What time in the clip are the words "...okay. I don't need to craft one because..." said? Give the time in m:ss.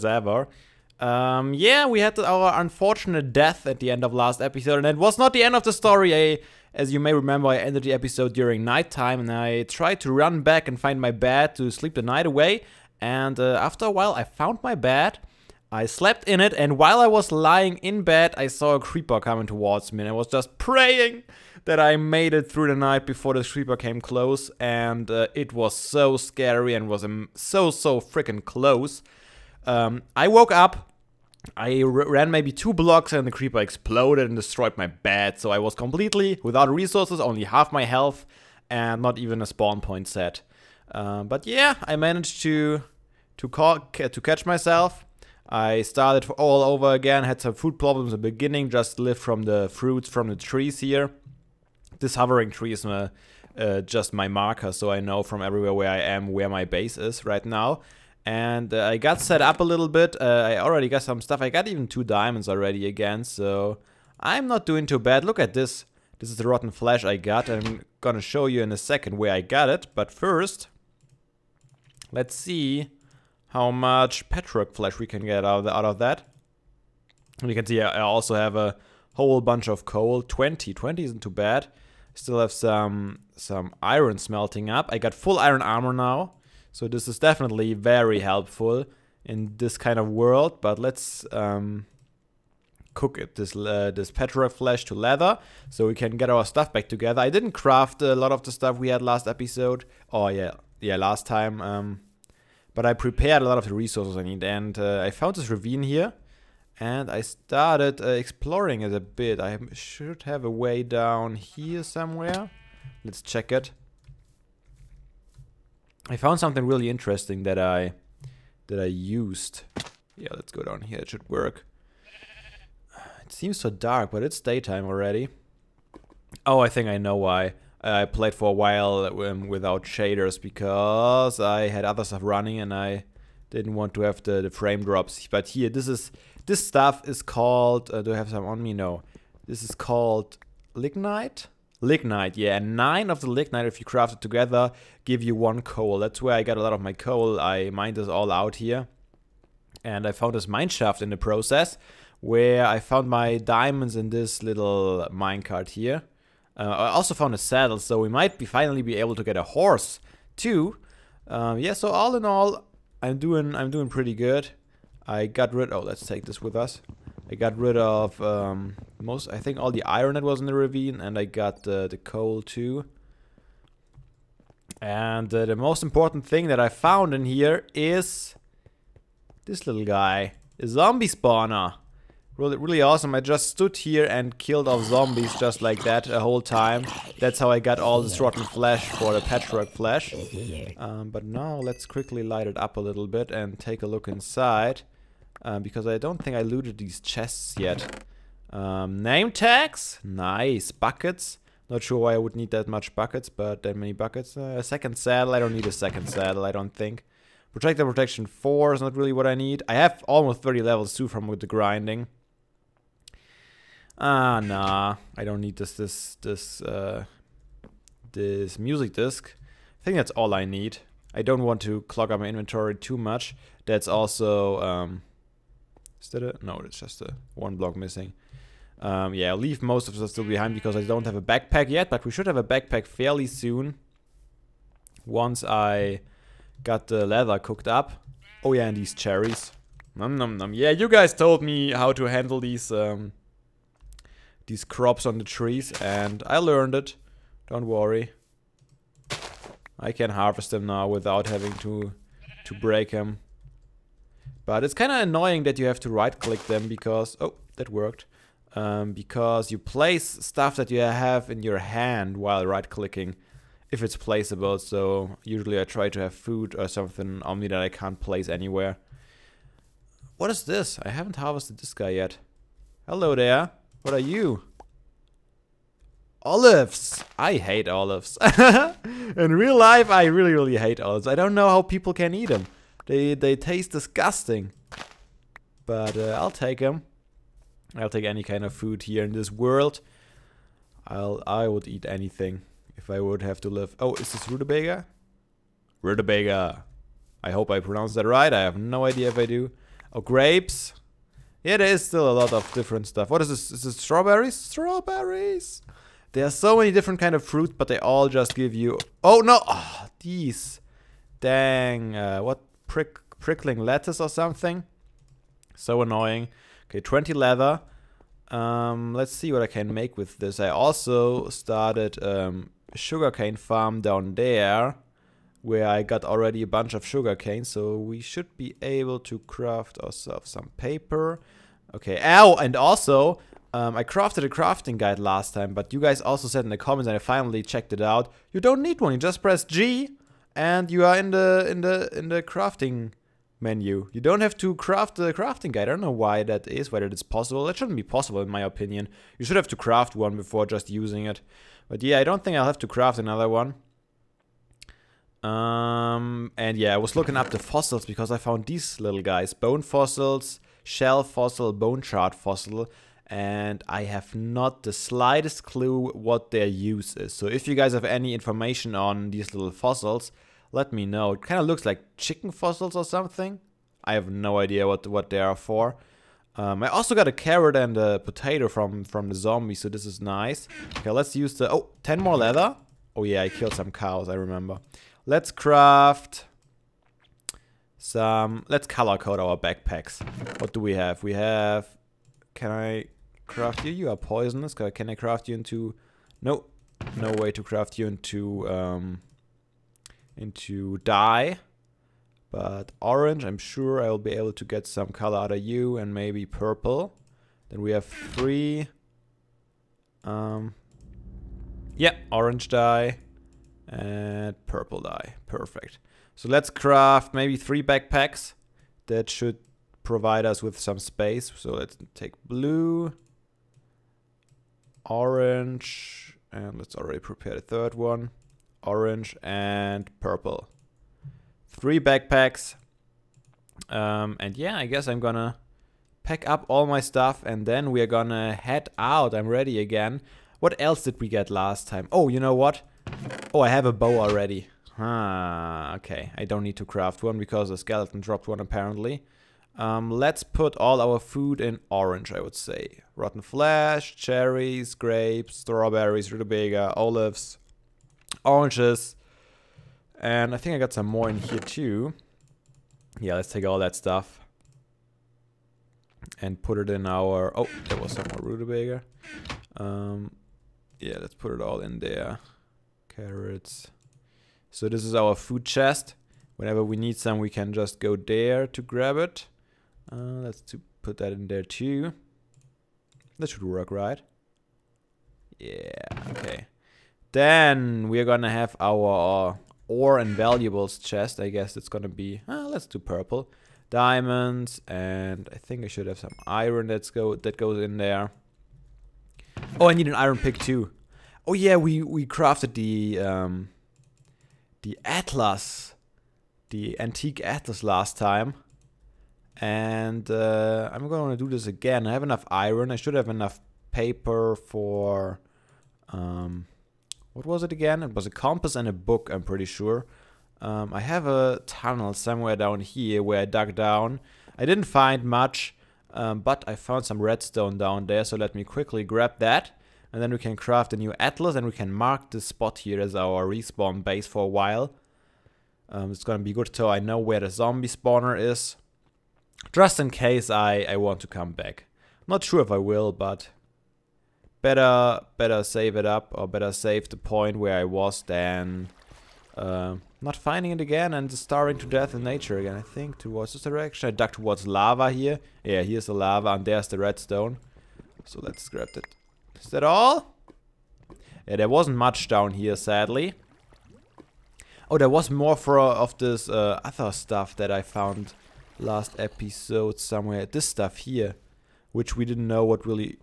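7:25.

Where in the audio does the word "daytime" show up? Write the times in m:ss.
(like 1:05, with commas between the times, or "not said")
2:04.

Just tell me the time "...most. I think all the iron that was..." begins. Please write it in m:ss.
2:49.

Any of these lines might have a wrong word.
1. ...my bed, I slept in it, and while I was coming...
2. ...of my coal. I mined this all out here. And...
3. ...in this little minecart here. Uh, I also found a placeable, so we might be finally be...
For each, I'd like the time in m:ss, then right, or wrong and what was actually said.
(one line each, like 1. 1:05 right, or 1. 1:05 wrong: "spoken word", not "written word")
1. 0:14 wrong: "lying", not "coming"
2. 2:26 right
3. 2:33 wrong: "saddle", not "placeable".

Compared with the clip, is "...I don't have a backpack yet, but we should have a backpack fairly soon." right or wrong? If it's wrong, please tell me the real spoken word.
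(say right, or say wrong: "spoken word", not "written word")
right.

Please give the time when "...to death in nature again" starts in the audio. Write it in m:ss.
9:11.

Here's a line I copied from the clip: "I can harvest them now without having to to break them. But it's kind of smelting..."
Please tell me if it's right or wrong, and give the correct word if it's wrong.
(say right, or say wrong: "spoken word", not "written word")
wrong: "annoying", not "smelting".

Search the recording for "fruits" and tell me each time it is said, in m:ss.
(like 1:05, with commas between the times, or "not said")
0:49, 5:07.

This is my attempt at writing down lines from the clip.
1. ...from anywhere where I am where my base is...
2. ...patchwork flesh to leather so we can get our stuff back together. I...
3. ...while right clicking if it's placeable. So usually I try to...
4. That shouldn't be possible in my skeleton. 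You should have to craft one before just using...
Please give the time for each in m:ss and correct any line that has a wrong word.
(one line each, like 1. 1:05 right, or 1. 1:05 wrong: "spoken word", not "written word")
1. 0:55 wrong: "everywhere", not "anywhere"
2. 1:34 right
3. 4:22 right
4. 5:47 wrong: "opinion", not "skeleton".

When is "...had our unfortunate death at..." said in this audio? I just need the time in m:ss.
0:01.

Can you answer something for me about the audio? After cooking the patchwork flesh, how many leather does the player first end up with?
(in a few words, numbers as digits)
20.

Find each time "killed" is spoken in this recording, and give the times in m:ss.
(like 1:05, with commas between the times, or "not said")
3:04, 6:23.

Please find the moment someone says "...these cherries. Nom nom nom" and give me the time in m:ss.
3:58.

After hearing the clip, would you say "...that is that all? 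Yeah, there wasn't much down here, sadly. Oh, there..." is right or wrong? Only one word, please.
right.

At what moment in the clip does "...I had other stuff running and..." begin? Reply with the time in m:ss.
2:11.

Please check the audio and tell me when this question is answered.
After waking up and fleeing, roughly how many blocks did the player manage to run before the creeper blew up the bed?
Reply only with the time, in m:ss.
0:32.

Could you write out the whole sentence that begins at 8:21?
Oh yeah, we we crafted the um, the atlas, the antique atlas last time, and uh, I'm gonna do this again.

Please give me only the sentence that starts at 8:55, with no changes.
Um, it's gonna be good so I know where the zombie spawner is, just in case I, I want to come back.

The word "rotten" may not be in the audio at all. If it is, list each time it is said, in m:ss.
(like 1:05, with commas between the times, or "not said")
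1:06, 3:08, 7:32.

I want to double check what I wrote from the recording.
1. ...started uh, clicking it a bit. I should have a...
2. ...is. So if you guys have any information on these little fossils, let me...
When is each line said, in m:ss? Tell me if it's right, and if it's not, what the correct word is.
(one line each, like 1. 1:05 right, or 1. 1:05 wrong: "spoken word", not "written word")
1. 1:47 wrong: "exploring", not "clicking"
2. 6:06 right.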